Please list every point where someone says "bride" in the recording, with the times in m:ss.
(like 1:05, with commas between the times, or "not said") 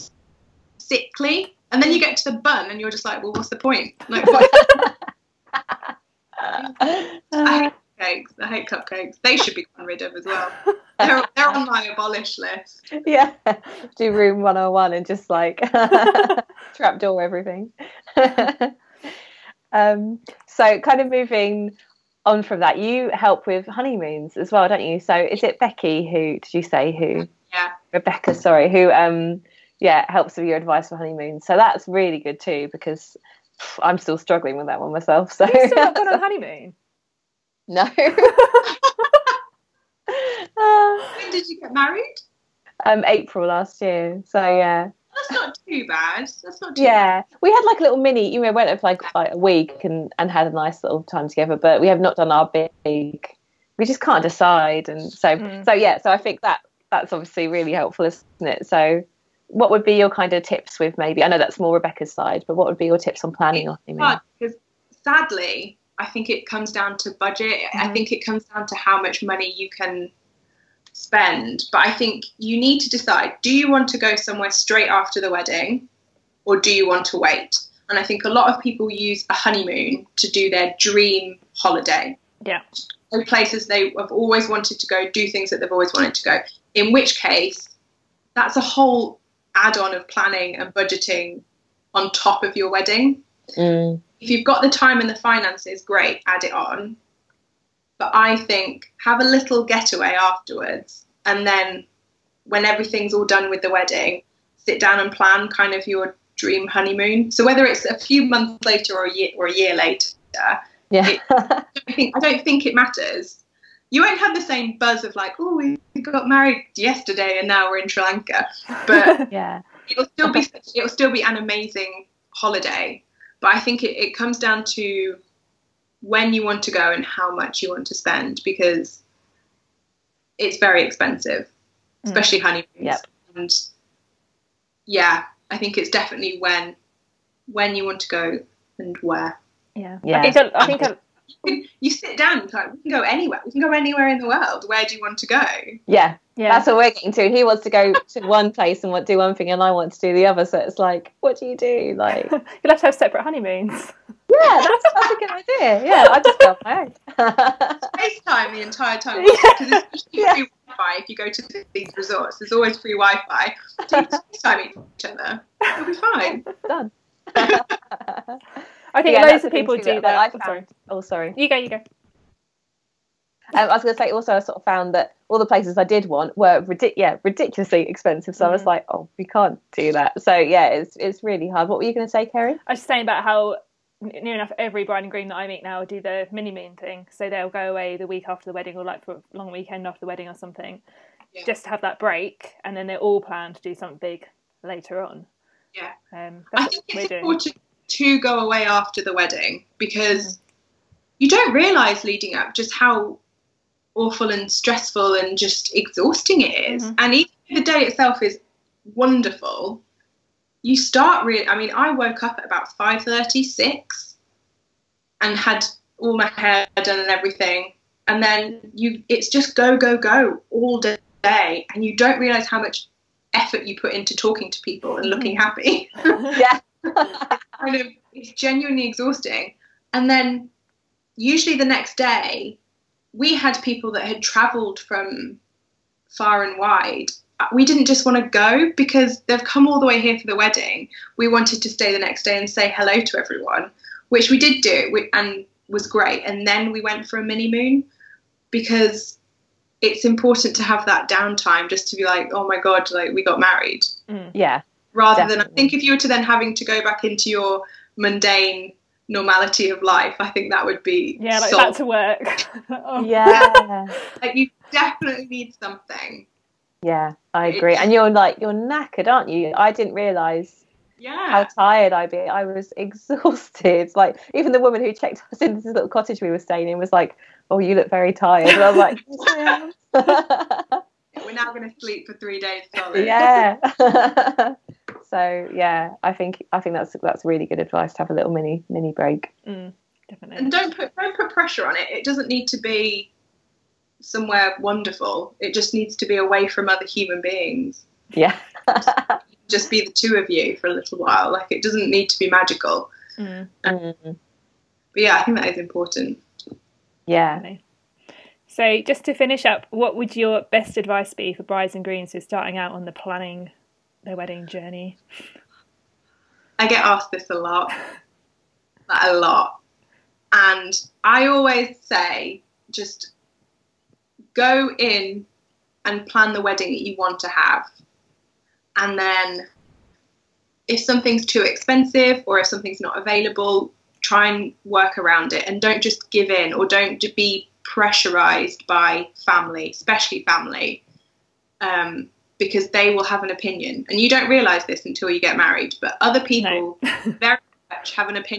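3:04, 5:11.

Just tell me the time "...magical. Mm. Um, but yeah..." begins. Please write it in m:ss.
5:02.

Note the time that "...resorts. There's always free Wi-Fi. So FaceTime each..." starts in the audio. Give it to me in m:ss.
2:41.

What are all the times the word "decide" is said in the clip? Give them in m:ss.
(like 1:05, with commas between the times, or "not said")
0:54, 1:12.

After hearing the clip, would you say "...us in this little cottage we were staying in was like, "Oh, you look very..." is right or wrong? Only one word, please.
right.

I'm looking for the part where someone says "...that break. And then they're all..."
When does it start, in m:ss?
3:11.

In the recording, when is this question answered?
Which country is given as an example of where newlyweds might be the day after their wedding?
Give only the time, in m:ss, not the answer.
1:57.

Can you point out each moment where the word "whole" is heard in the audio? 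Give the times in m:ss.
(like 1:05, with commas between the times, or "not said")
1:28.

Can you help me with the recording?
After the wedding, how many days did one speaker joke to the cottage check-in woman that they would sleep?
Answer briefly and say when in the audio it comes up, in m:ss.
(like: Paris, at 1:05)
3, at 4:42.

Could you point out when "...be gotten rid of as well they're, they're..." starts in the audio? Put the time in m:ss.
0:09.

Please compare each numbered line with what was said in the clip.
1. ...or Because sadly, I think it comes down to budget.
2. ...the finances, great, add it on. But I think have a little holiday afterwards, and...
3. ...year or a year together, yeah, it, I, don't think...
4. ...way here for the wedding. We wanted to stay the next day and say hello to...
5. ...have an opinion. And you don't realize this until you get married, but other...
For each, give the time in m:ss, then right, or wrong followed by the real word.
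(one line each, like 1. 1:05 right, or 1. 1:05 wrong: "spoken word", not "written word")
1. 1:03 right
2. 1:35 wrong: "getaway", not "holiday"
3. 1:49 wrong: "later", not "together"
4. 3:59 right
5. 5:43 right.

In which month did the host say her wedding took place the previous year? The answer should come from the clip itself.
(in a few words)
April.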